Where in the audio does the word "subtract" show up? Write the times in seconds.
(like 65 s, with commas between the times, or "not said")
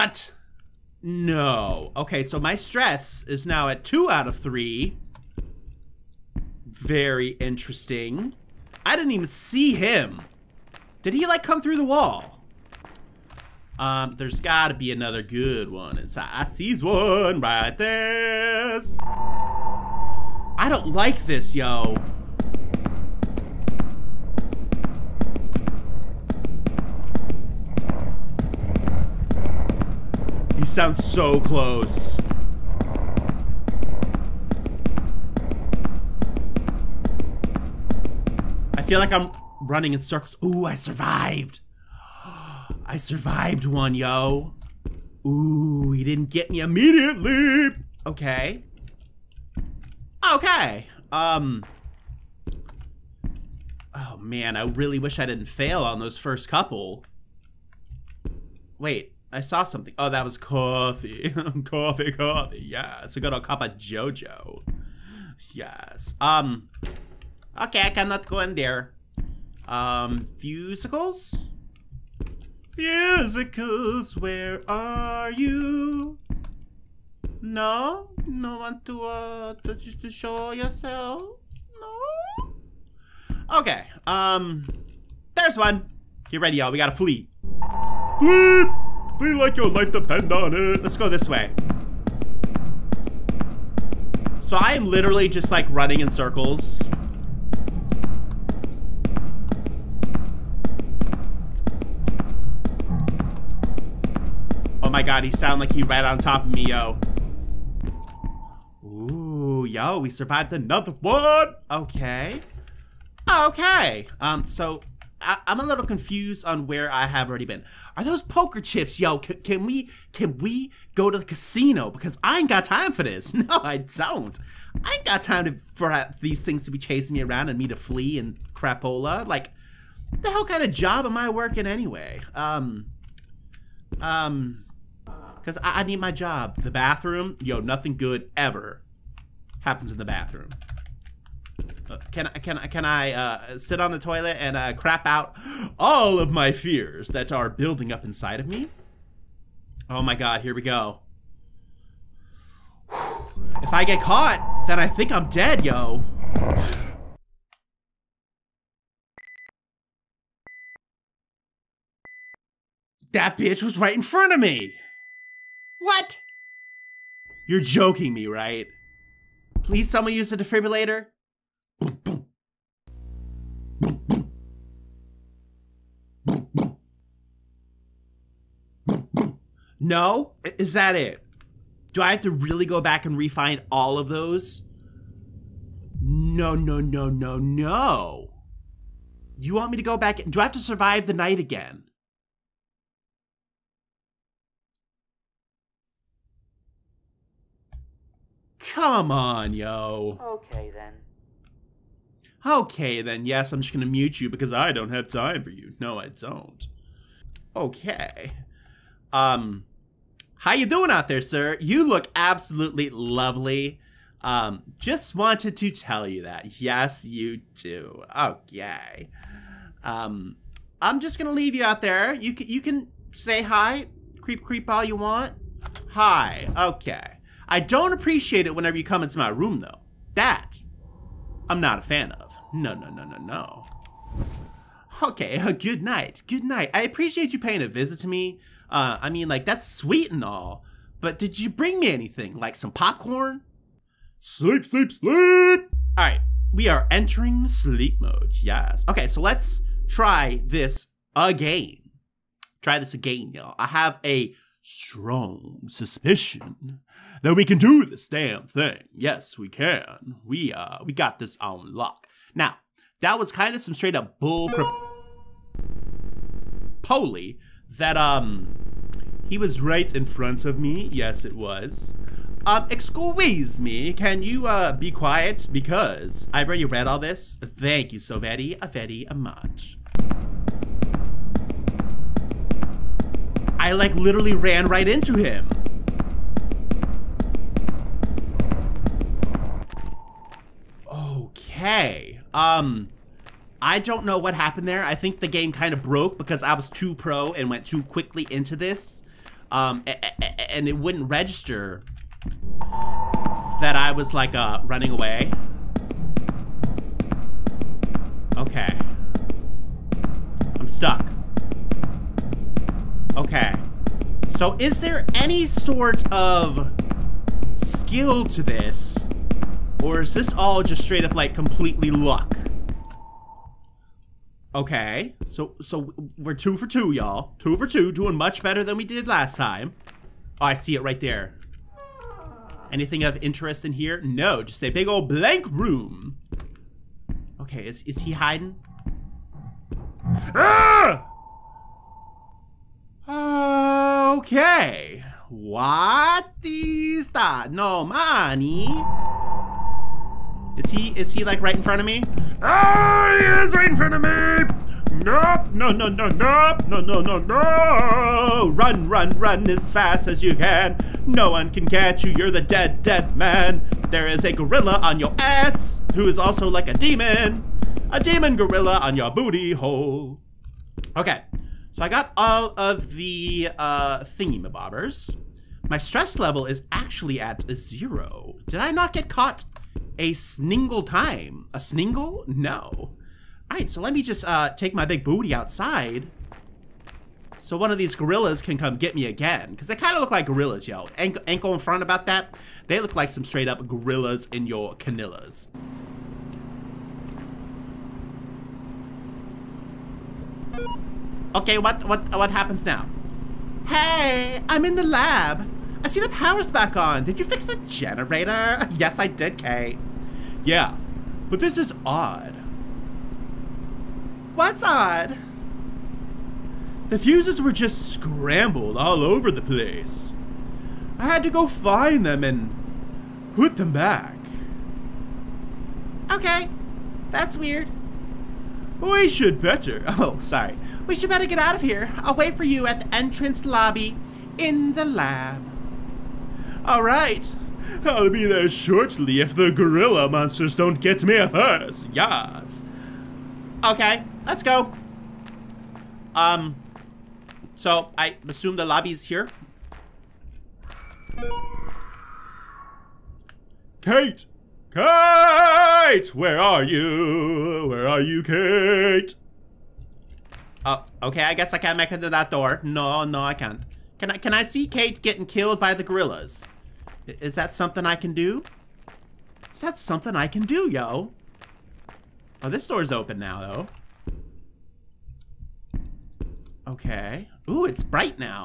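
not said.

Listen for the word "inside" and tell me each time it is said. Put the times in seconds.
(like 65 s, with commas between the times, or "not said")
15 s, 148 s.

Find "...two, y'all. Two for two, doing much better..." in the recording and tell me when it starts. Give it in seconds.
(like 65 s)
326 s.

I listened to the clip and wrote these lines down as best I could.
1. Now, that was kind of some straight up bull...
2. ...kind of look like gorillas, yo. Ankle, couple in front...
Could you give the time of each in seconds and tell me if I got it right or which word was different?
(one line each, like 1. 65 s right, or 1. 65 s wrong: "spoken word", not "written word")
1. 262 s right
2. 389 s wrong: "ankle", not "couple".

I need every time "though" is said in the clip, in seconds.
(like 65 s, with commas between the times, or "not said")
229 s, 474 s.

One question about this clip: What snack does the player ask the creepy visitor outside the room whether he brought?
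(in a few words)
Popcorn.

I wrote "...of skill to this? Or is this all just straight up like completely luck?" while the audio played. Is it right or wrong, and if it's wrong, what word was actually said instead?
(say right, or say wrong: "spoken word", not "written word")
right.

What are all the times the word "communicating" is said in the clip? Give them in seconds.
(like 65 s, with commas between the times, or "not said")
not said.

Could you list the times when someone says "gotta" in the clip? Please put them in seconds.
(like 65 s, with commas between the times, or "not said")
14 s, 86 s.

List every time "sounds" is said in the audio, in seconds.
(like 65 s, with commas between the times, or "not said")
30 s, 105 s.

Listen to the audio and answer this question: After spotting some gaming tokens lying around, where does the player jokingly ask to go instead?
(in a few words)
The casino.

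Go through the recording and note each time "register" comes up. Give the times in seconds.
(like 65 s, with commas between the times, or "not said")
301 s.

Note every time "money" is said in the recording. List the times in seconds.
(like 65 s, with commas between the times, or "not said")
347 s.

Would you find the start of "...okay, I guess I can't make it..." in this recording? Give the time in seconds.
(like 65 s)
461 s.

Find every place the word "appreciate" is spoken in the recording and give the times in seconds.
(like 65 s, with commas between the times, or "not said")
227 s, 236 s.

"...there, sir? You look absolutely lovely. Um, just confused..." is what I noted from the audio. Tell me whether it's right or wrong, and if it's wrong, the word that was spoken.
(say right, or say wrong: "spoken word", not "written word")
wrong: "wanted", not "confused".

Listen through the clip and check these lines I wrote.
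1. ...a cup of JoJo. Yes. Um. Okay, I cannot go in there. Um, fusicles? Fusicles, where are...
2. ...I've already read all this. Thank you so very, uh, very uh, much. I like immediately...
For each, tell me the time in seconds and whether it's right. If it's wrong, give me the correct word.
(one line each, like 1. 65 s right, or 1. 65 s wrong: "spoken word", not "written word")
1. 63 s right
2. 276 s wrong: "literally", not "immediately".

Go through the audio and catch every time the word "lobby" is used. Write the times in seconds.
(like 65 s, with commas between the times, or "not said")
433 s, 448 s.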